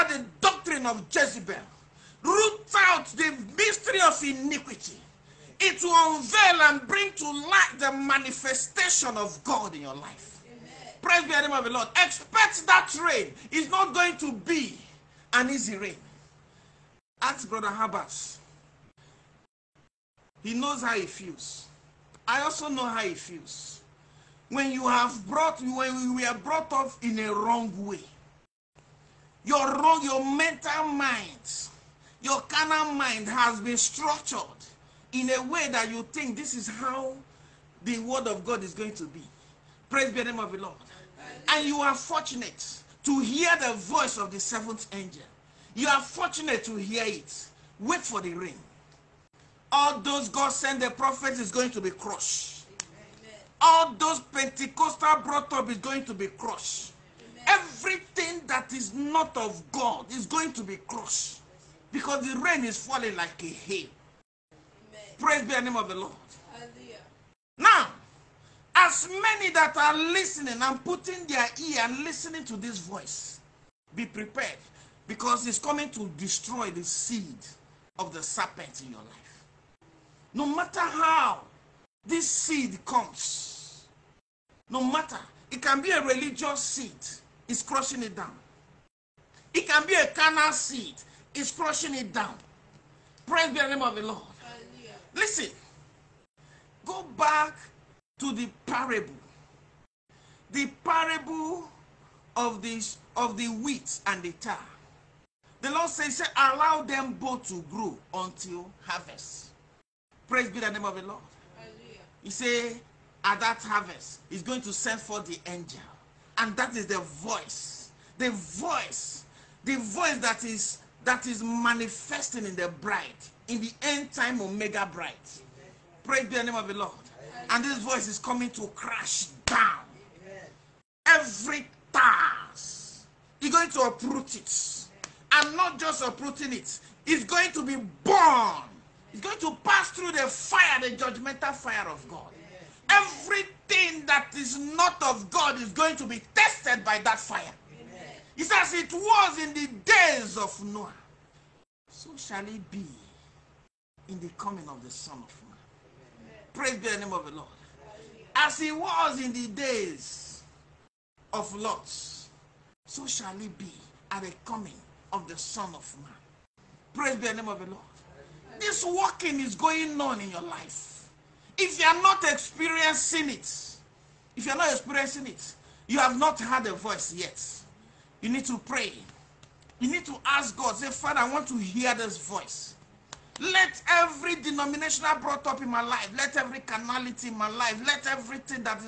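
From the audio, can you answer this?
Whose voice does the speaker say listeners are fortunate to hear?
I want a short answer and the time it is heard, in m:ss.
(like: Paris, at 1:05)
the seventh angel, at 0:44.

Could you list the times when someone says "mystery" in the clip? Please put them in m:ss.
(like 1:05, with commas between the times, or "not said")
0:03.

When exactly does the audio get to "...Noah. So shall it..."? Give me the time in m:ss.
2:30.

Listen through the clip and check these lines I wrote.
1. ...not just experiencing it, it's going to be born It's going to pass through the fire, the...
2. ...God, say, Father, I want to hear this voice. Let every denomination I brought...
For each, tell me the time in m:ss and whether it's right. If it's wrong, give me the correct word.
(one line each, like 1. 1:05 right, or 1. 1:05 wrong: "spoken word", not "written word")
1. 2:15 wrong: "uprooting", not "experiencing"
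2. 3:00 right.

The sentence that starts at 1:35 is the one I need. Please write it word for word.
Listen, go back to the parable.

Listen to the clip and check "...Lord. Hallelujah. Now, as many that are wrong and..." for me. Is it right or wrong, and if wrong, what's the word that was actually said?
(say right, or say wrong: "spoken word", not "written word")
wrong: "listening", not "wrong".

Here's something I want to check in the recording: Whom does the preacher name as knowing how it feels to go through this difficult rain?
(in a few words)
Brother Habas.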